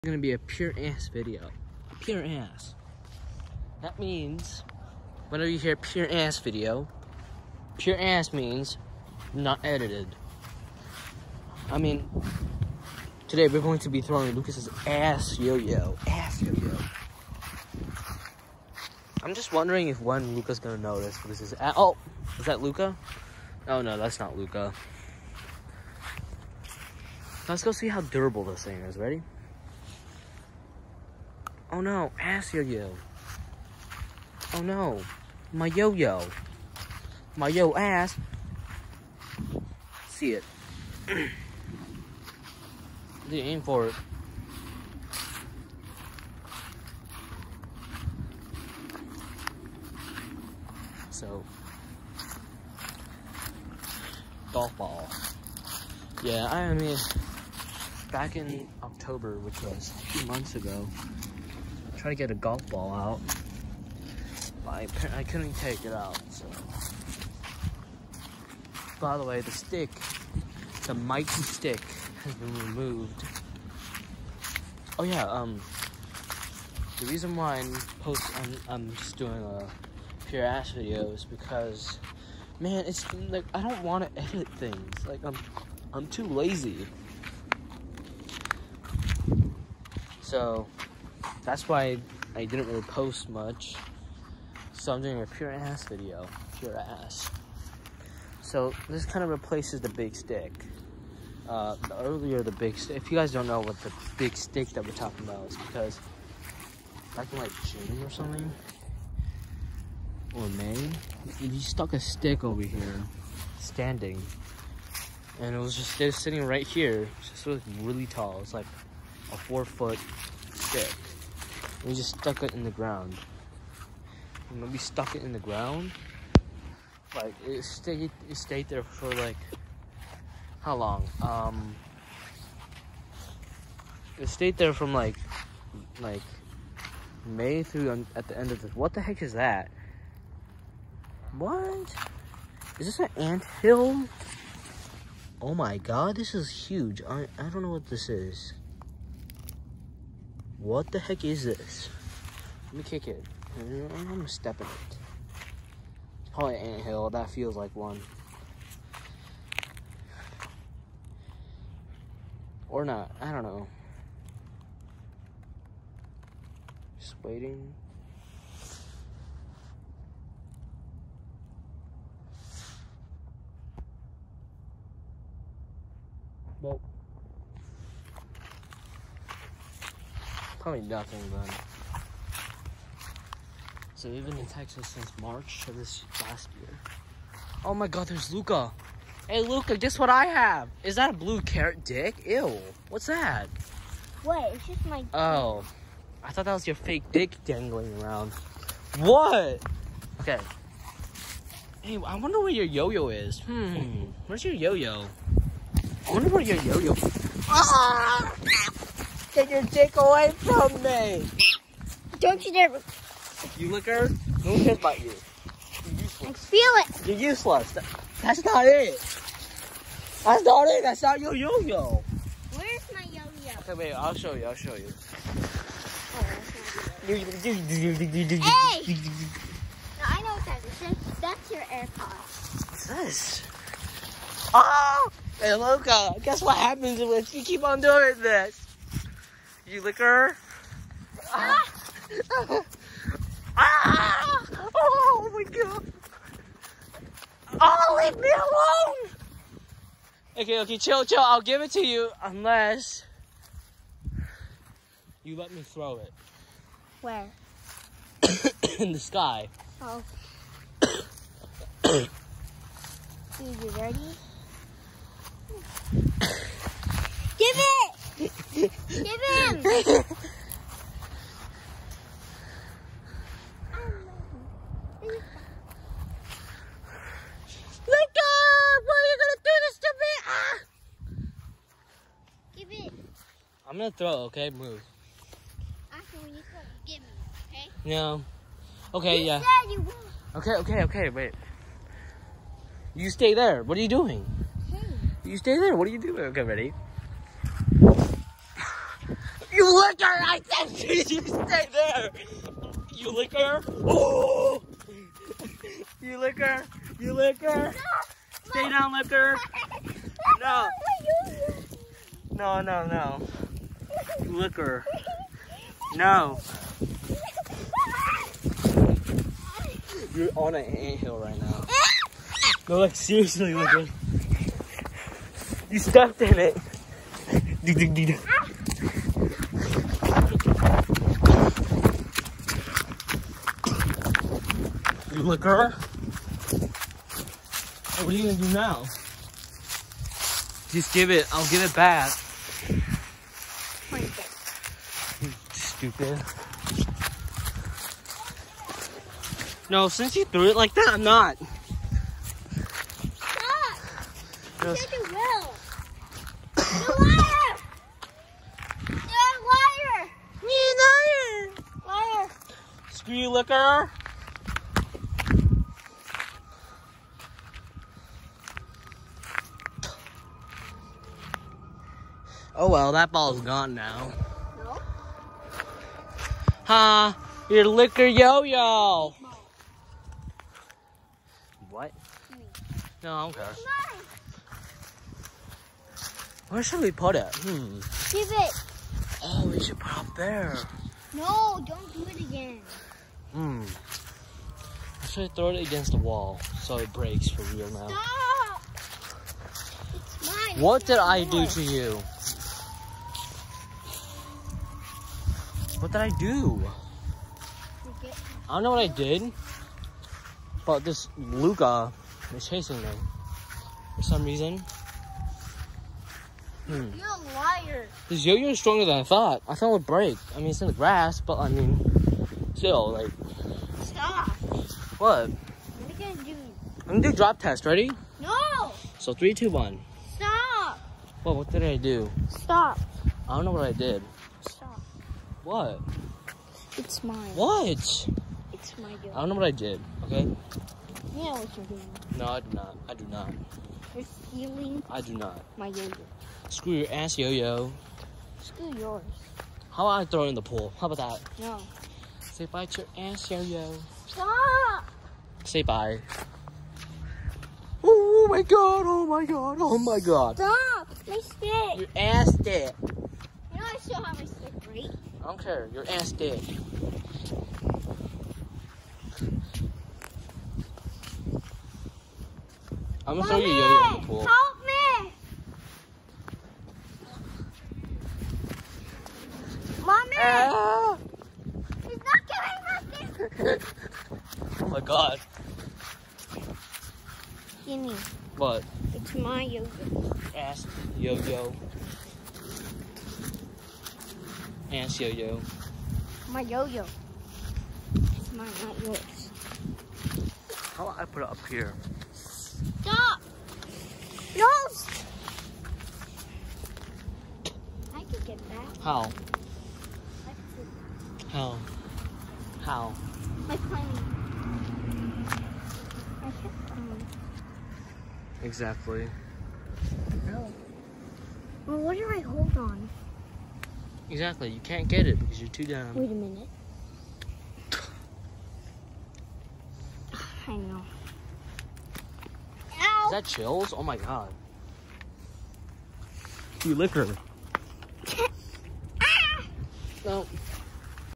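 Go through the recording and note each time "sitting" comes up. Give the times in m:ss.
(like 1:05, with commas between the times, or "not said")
1:56.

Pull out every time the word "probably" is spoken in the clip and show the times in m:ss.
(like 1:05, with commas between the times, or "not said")
2:36, 3:00.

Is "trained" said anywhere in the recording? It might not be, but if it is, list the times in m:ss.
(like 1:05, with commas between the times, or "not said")
not said.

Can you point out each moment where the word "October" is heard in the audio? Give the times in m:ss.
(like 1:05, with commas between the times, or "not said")
0:58.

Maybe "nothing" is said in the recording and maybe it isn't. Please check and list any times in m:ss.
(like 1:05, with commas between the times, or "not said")
3:00, 8:03.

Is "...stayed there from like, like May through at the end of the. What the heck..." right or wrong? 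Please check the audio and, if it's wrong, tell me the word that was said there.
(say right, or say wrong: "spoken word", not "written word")
right.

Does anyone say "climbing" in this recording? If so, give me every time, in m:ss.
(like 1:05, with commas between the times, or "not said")
8:33.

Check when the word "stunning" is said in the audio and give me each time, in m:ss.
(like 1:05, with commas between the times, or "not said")
not said.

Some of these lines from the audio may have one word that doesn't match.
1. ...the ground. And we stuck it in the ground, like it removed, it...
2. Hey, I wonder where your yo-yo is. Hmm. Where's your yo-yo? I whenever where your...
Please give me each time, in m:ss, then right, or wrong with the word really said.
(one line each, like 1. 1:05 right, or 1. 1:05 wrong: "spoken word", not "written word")
1. 2:02 wrong: "stayed", not "removed"
2. 3:21 wrong: "wonder", not "whenever".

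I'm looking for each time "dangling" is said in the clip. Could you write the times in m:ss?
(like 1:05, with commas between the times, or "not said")
3:17.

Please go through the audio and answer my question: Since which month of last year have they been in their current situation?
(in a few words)
March.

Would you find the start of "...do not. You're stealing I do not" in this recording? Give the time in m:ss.
7:22.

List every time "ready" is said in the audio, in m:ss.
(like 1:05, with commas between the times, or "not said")
0:28, 4:23, 4:56, 7:07.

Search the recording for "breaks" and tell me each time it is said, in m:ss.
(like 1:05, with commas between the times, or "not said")
6:36, 6:59.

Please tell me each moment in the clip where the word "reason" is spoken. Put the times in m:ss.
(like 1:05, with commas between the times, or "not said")
1:17, 6:54.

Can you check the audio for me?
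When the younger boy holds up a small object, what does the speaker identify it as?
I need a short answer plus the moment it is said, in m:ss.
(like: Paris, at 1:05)
AirPod, at 3:51.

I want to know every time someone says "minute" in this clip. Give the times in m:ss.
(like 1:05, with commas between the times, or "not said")
8:46.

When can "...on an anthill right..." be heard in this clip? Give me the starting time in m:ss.
5:20.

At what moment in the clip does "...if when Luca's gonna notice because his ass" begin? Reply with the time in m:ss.
0:19.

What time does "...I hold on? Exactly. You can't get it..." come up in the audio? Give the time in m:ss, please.
8:42.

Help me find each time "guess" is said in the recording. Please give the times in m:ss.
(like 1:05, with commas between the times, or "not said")
3:09, 3:56.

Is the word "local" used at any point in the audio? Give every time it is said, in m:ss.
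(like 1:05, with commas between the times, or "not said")
not said.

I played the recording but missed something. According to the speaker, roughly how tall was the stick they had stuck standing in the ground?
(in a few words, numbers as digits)
4 foot.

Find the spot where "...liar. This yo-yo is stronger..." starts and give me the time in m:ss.
6:57.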